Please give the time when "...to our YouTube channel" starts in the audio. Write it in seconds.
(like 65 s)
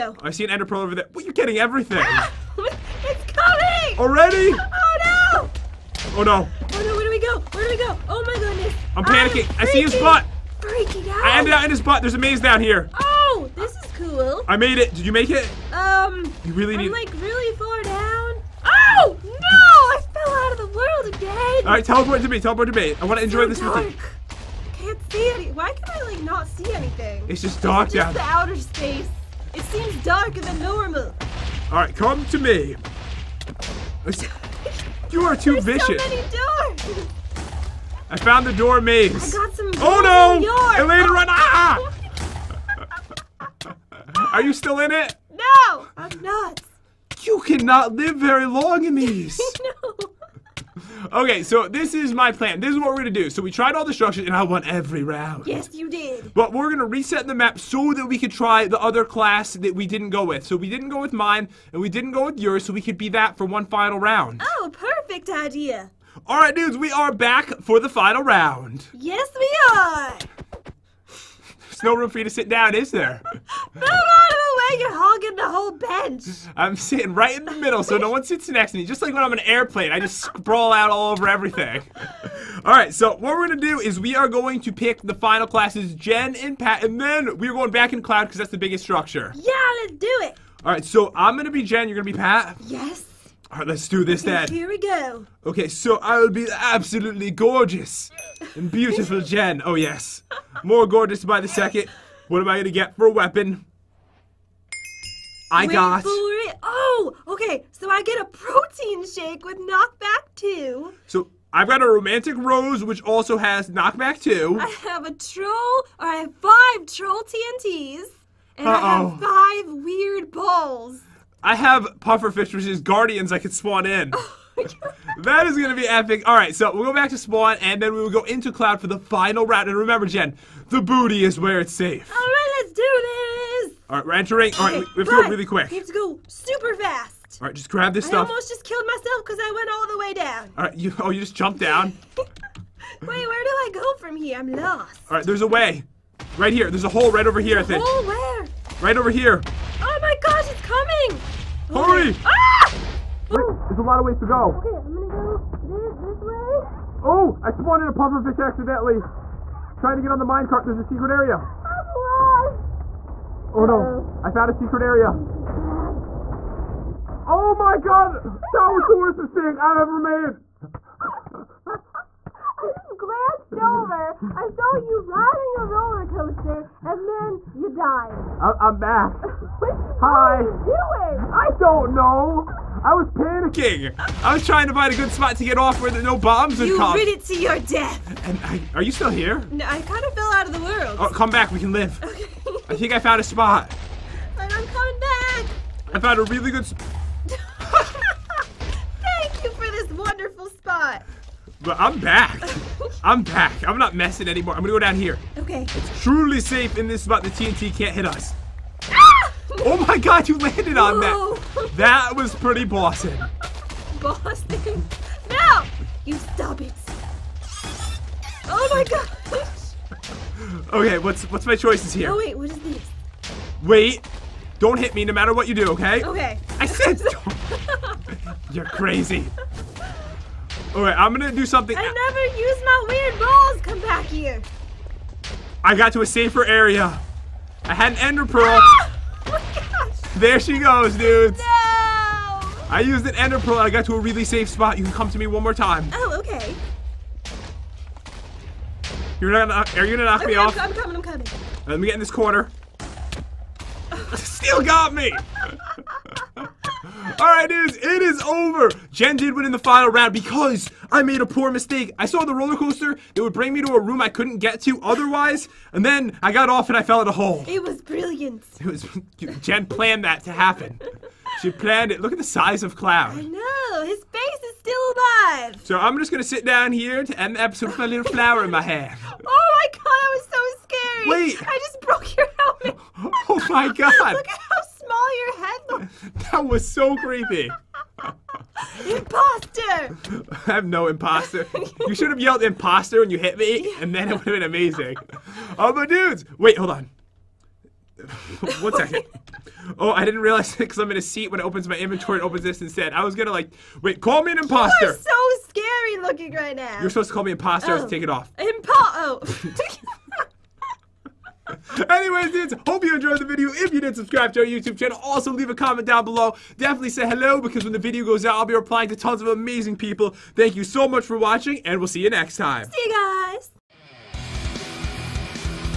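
314 s.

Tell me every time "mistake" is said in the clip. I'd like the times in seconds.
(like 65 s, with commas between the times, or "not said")
169 s, 261 s.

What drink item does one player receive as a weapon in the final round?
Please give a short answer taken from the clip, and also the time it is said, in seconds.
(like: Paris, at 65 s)
Protein shake, at 108 s.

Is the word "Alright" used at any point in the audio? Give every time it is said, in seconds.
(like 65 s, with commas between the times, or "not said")
21 s, 31 s, 230 s, 257 s.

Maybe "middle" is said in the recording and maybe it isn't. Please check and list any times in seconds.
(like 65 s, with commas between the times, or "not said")
77 s.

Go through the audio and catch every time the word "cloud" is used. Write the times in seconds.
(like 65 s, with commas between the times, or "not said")
88 s, 128 s, 272 s.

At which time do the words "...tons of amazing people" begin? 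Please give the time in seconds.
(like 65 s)
318 s.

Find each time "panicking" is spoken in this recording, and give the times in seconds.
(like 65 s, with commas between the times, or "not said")
9 s, 183 s.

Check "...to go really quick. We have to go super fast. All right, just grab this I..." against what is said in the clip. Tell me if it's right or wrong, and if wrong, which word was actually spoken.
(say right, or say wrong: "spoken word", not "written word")
right.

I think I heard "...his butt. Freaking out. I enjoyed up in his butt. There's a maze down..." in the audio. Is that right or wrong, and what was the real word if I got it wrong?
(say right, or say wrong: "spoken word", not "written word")
wrong: "ended", not "enjoyed".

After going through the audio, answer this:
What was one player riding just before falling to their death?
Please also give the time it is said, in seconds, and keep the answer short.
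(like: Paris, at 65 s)
Minecart, at 160 s.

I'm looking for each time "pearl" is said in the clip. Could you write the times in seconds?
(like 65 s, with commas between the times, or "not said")
0 s, 238 s, 243 s.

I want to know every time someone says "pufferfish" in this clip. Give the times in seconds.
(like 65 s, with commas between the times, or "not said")
122 s, 157 s.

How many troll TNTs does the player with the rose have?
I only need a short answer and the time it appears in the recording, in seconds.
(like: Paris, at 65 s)
5, at 116 s.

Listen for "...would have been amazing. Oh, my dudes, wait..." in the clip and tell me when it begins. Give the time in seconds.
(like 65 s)
294 s.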